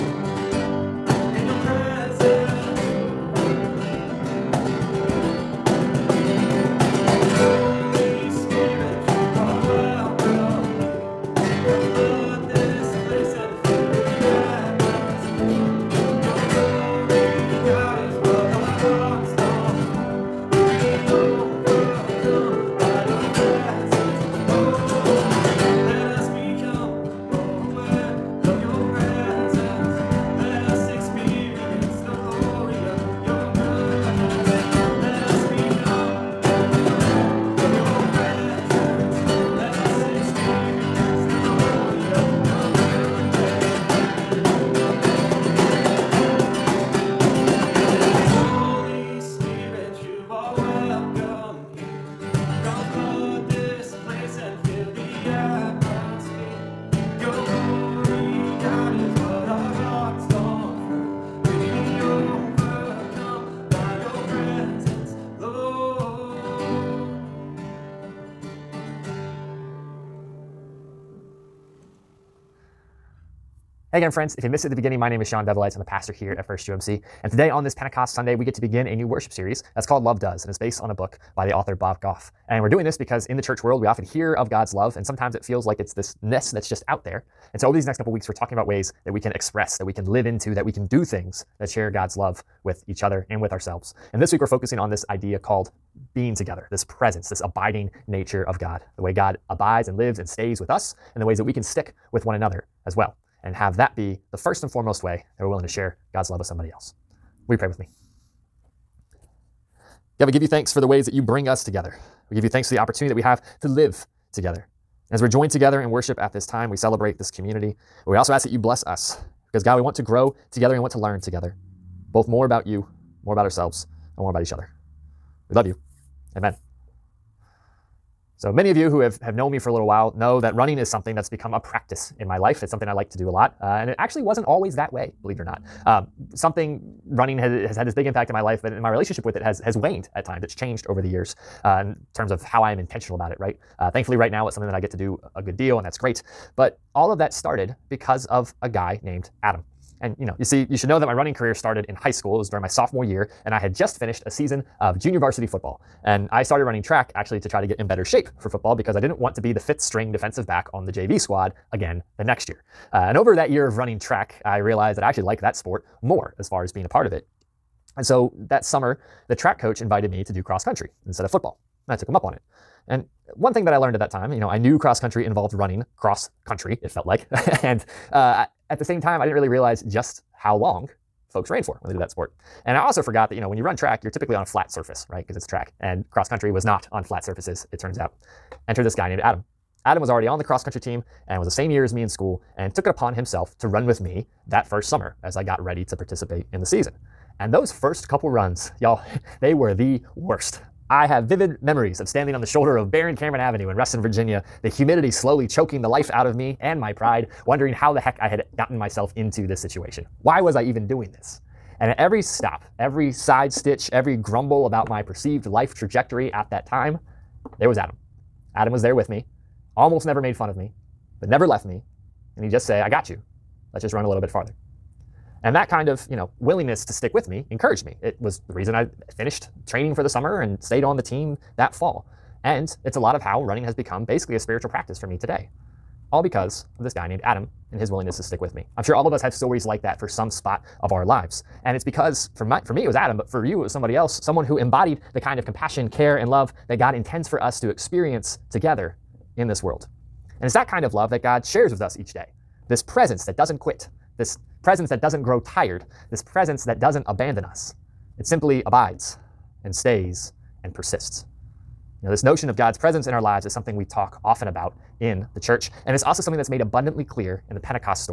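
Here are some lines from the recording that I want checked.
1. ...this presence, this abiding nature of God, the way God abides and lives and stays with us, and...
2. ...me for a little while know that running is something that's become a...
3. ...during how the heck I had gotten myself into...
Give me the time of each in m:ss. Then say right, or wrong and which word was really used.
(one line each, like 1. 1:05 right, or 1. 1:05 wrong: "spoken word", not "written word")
1. 1:36 right
2. 2:09 right
3. 3:27 wrong: "wondering", not "during".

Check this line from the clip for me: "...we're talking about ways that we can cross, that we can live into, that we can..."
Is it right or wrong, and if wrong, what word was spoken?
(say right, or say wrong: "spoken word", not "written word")
wrong: "express", not "cross".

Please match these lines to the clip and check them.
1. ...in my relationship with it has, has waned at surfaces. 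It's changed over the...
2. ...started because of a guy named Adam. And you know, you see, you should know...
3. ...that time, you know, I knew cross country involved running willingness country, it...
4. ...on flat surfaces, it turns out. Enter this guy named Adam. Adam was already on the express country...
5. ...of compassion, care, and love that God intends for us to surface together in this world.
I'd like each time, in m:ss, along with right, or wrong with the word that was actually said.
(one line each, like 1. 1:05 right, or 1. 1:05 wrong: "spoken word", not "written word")
1. 2:18 wrong: "times", not "surfaces"
2. 2:27 right
3. 2:53 wrong: "cross", not "willingness"
4. 3:06 wrong: "cross", not "express"
5. 4:05 wrong: "experience", not "surface".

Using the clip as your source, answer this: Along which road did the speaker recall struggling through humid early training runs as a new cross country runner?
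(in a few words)
Baron Cameron Avenue.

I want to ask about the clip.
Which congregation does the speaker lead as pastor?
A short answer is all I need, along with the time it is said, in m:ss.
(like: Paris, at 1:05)
First UMC, at 1:16.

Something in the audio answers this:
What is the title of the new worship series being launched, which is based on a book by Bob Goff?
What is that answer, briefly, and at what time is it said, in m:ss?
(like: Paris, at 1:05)
Love Does, at 1:20.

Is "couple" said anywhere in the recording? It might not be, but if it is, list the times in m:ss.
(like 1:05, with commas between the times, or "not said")
1:27, 3:18.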